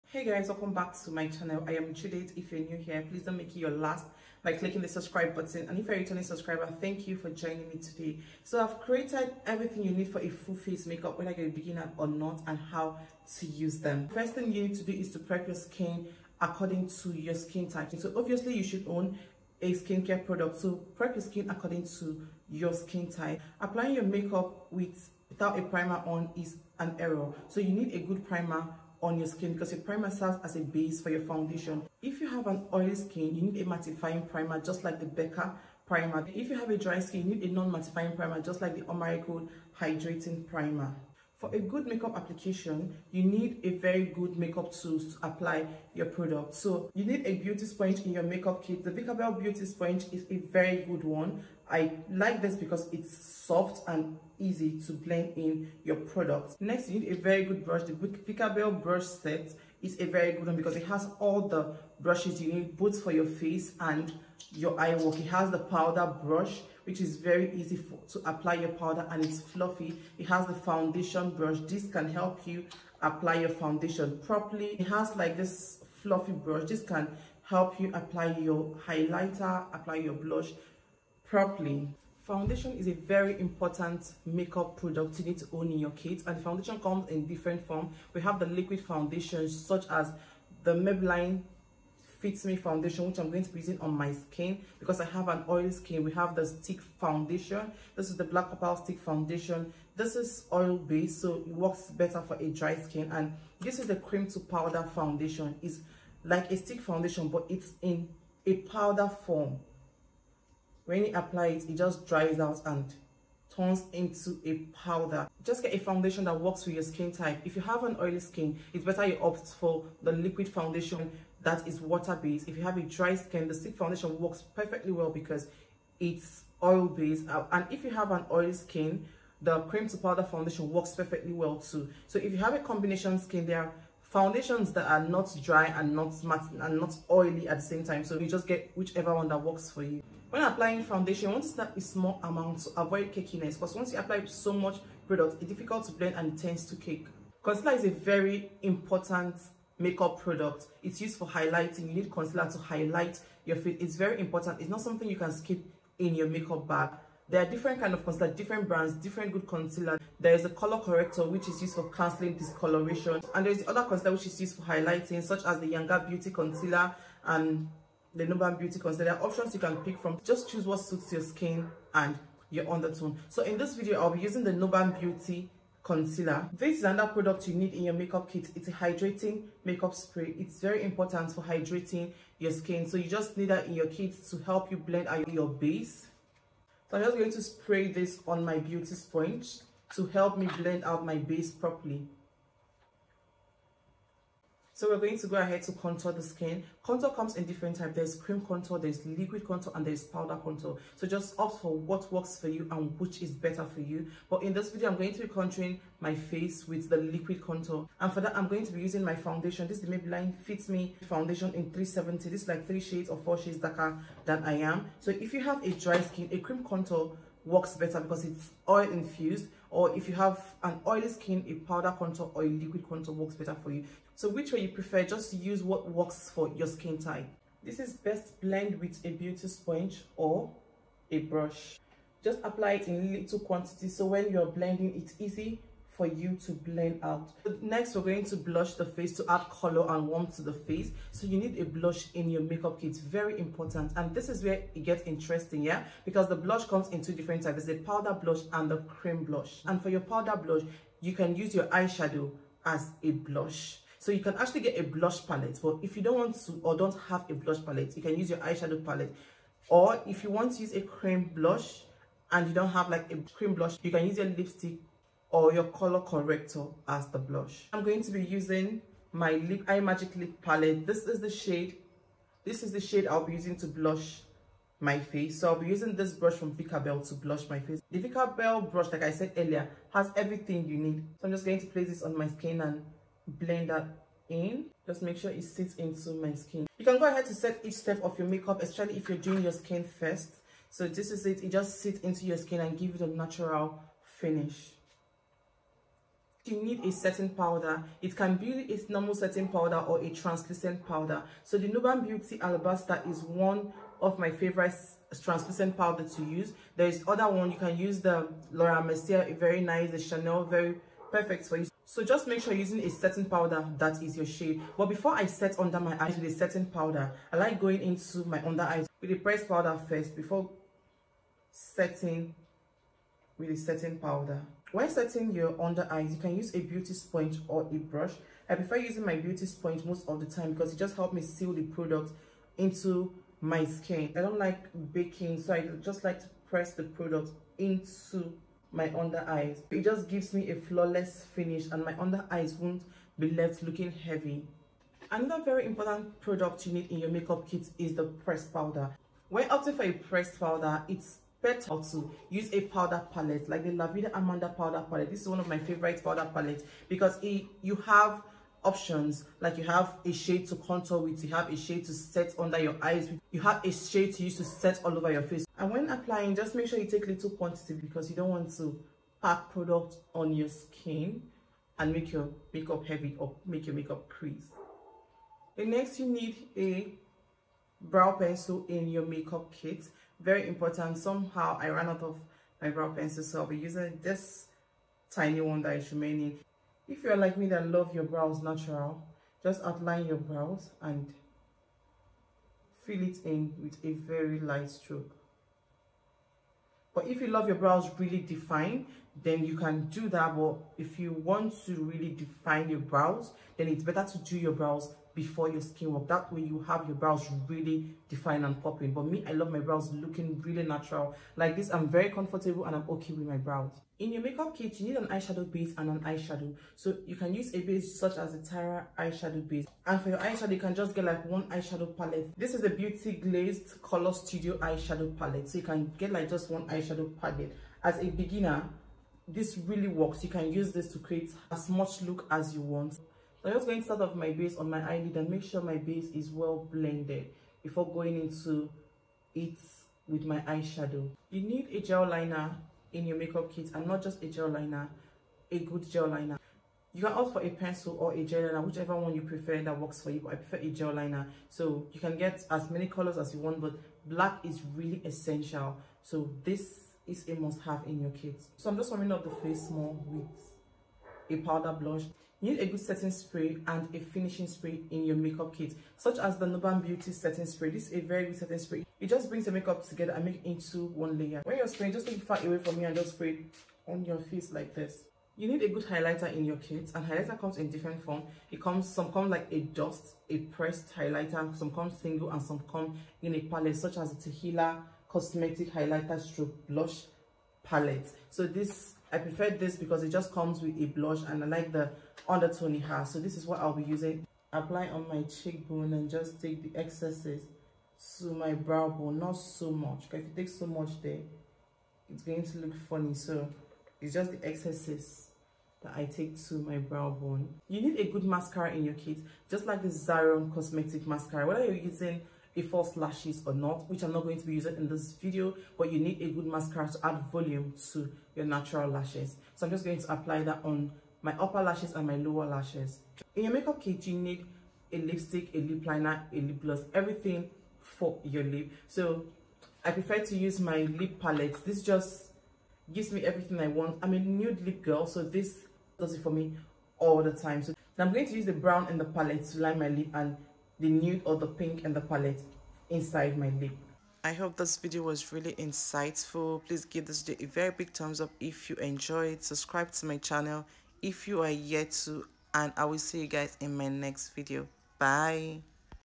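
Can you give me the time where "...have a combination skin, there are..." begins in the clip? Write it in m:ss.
2:12.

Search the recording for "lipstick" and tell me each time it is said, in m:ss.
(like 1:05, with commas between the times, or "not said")
4:24, 8:44.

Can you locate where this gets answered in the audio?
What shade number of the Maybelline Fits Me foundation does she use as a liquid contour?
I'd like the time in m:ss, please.
3:31.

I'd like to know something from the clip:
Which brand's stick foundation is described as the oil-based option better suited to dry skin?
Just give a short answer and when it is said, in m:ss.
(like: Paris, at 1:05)
Black Opal, at 1:38.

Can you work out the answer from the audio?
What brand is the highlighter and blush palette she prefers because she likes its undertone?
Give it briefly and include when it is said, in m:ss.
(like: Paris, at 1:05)
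Tequila Cosmetic, at 8:04.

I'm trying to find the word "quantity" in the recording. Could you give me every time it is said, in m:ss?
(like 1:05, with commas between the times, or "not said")
3:53, 6:07.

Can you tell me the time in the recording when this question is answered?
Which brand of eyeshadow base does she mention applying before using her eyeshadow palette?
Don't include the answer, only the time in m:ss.
6:58.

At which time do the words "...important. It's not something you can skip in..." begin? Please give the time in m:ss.
2:34.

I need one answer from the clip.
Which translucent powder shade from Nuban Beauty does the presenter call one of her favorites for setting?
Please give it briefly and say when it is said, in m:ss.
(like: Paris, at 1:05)
Alabaster, at 5:02.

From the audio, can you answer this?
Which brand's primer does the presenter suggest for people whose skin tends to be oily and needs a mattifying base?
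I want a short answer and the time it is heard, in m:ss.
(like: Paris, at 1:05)
Becca, at 0:35.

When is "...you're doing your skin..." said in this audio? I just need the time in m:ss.
4:49.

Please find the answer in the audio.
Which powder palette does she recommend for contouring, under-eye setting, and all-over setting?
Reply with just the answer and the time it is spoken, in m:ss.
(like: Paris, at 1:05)
Lavida Amanda, at 5:53.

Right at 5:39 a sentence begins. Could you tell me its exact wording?
It just gives me a flawless finish and my under eyes won't be left looking heavy.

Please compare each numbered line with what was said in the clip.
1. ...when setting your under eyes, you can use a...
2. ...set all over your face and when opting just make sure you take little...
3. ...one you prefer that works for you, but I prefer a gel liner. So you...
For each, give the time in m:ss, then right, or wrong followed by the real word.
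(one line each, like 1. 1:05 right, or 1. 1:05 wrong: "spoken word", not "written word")
1. 5:24 right
2. 6:04 wrong: "applying", not "opting"
3. 7:28 right.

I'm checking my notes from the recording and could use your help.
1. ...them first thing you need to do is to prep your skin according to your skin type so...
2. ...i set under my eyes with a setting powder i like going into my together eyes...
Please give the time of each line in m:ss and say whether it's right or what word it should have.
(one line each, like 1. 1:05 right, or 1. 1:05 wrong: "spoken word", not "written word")
1. 0:13 right
2. 5:15 wrong: "under", not "together".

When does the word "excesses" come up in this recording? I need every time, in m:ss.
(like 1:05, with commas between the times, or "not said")
8:16, 8:24.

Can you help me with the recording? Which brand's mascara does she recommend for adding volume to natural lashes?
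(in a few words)
Zaron Cosmetic.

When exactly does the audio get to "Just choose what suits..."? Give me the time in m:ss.
2:50.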